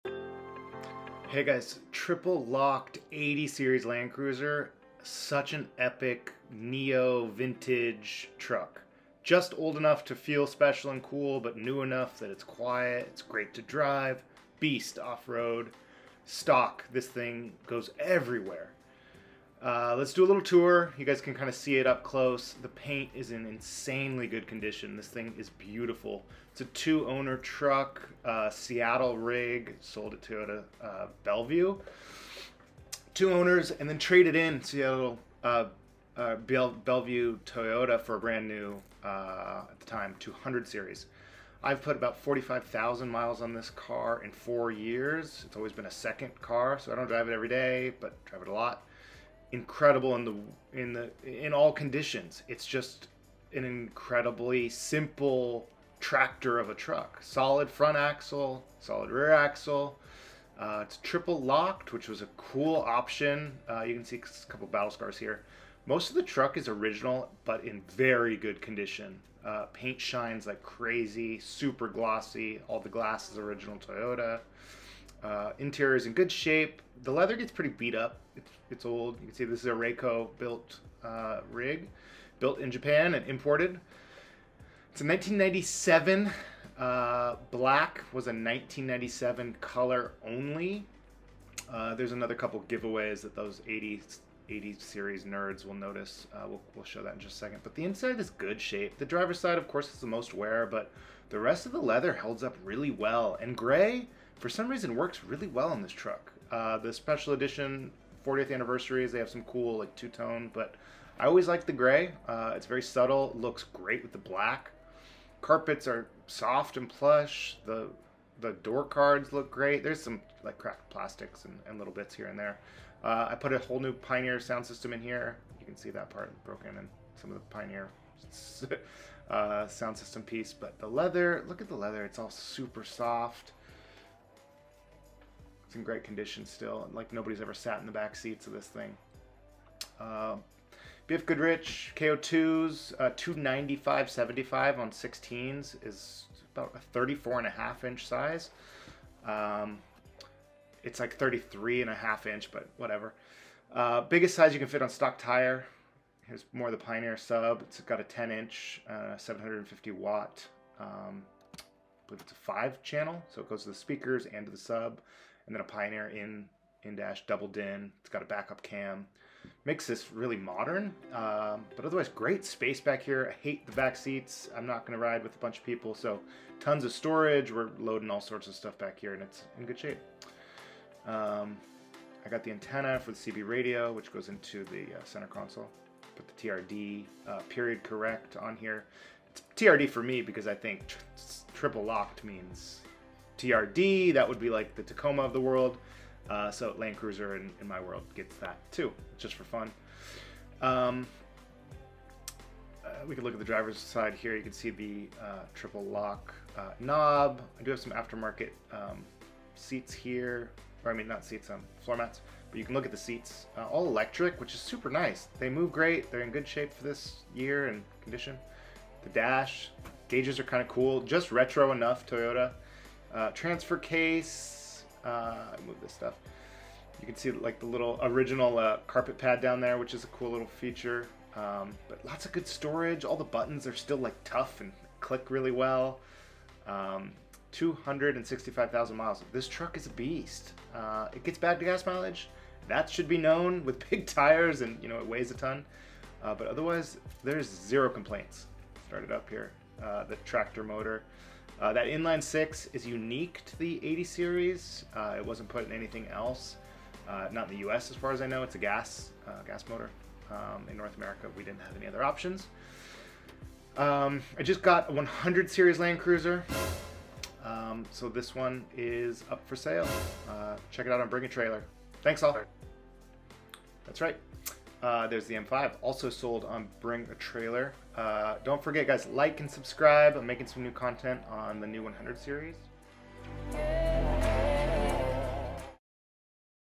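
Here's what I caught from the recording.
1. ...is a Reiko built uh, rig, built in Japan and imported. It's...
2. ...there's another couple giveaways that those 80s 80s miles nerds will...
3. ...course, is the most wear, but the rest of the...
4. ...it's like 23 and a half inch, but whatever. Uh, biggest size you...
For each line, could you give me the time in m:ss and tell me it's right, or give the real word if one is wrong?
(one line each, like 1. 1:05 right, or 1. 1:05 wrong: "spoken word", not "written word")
1. 1:19 right
2. 1:31 wrong: "series", not "miles"
3. 1:39 right
4. 2:30 wrong: "33", not "23".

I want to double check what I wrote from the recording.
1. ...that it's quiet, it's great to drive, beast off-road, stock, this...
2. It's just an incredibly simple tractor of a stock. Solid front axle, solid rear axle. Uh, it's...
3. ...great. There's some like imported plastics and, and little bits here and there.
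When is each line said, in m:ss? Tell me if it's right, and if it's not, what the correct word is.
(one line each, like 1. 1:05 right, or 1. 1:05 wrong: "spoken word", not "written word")
1. 0:12 right
2. 0:52 wrong: "truck", not "stock"
3. 1:59 wrong: "cracked", not "imported".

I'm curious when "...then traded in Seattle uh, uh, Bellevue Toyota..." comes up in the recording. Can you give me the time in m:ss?
0:33.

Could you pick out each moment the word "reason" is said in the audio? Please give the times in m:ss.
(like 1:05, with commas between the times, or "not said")
1:44.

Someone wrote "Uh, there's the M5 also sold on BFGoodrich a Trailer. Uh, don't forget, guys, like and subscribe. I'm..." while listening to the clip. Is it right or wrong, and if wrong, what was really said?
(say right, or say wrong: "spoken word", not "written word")
wrong: "Bring", not "BFGoodrich".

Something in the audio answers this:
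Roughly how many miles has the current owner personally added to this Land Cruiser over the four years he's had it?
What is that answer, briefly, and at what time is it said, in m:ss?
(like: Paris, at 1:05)
45,000, at 0:42.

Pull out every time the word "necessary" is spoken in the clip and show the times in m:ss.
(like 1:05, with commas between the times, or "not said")
not said.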